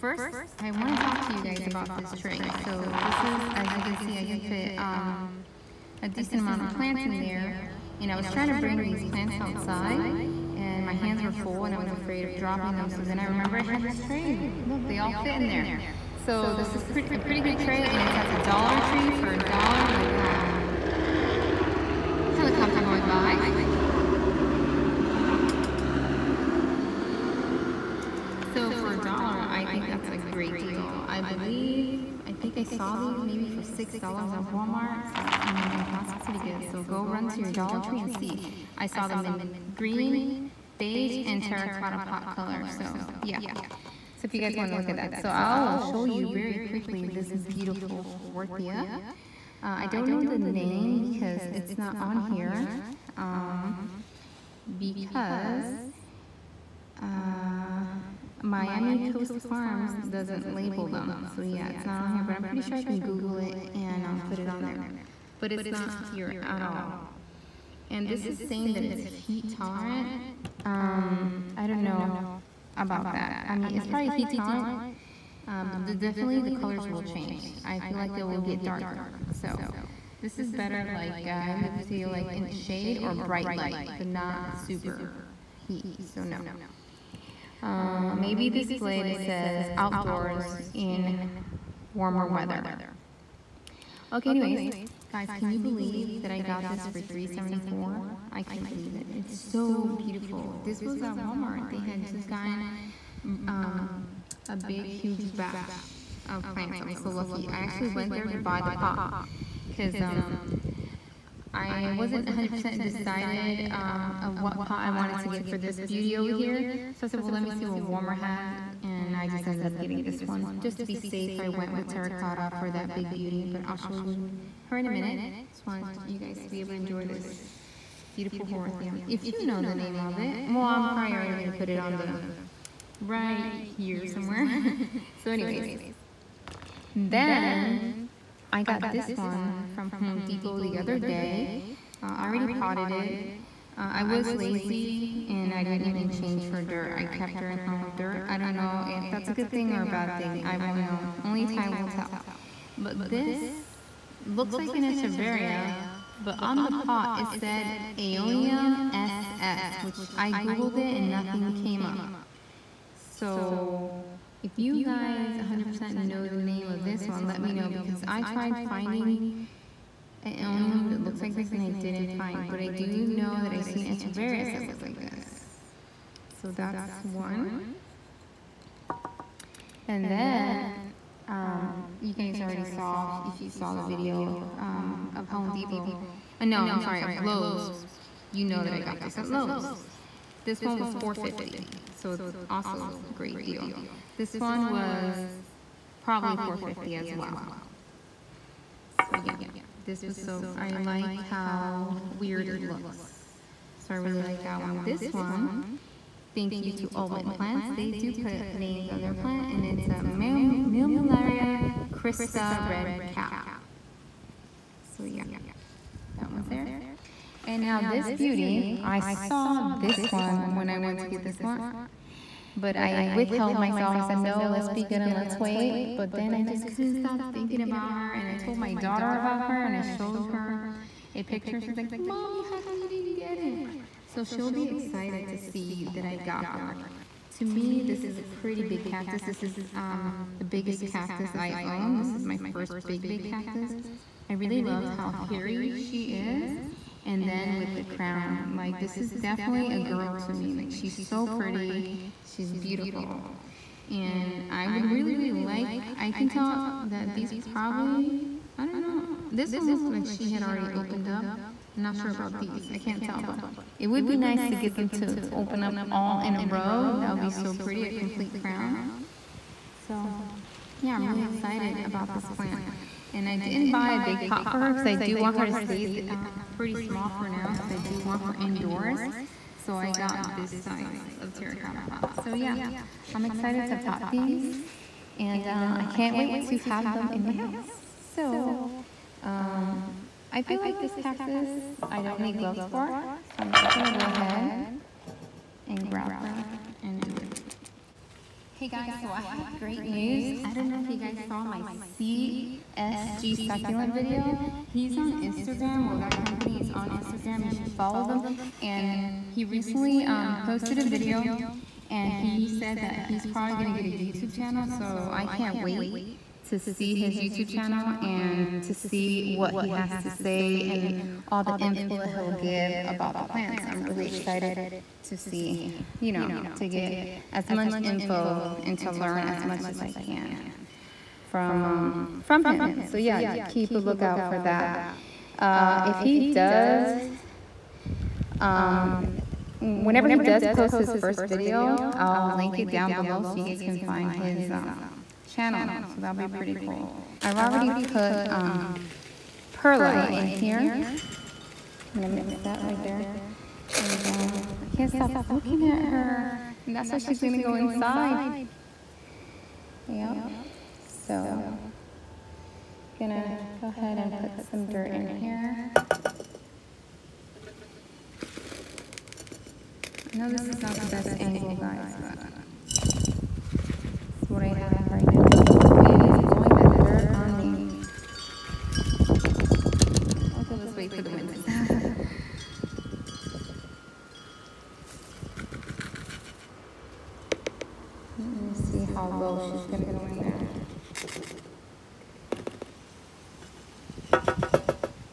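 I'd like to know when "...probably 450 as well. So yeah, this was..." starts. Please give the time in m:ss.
3:16.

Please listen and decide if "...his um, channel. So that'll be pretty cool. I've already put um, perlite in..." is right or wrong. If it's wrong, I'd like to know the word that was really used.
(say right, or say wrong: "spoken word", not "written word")
right.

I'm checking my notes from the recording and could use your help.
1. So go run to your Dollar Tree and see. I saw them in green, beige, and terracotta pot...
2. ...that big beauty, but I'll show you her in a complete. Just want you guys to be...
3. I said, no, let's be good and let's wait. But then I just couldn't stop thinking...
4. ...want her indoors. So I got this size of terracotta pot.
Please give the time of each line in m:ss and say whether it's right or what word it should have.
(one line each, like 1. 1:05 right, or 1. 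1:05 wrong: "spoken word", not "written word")
1. 0:36 right
2. 2:02 wrong: "minute", not "complete"
3. 3:43 right
4. 4:37 right.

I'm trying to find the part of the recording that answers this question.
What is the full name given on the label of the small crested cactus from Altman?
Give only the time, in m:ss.
3:30.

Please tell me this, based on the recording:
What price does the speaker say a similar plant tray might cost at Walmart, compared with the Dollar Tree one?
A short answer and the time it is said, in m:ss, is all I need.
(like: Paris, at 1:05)
$6, at 0:33.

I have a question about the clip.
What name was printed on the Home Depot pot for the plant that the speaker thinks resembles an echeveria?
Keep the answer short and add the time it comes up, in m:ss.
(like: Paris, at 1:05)
Aeonium SS, at 2:37.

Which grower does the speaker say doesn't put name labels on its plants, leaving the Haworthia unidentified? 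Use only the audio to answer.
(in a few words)
Miami Coast Farms.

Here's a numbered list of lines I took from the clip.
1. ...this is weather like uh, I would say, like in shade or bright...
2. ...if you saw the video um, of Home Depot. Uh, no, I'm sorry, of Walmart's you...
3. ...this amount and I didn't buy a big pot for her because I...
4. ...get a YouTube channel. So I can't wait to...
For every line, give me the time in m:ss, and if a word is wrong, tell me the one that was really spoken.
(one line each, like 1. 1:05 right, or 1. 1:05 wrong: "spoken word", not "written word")
1. 1:20 wrong: "better", not "weather"
2. 3:03 wrong: "Lowe", not "Walmart"
3. 4:32 wrong: "plant", not "amount"
4. 5:13 right.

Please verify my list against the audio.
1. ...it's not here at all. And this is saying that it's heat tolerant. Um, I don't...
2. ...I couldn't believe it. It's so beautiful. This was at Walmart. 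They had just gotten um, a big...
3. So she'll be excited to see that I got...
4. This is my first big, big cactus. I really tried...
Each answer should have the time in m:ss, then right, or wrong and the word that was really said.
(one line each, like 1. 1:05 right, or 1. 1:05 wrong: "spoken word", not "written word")
1. 1:05 right
2. 1:38 right
3. 3:54 right
4. 4:01 wrong: "loved", not "tried".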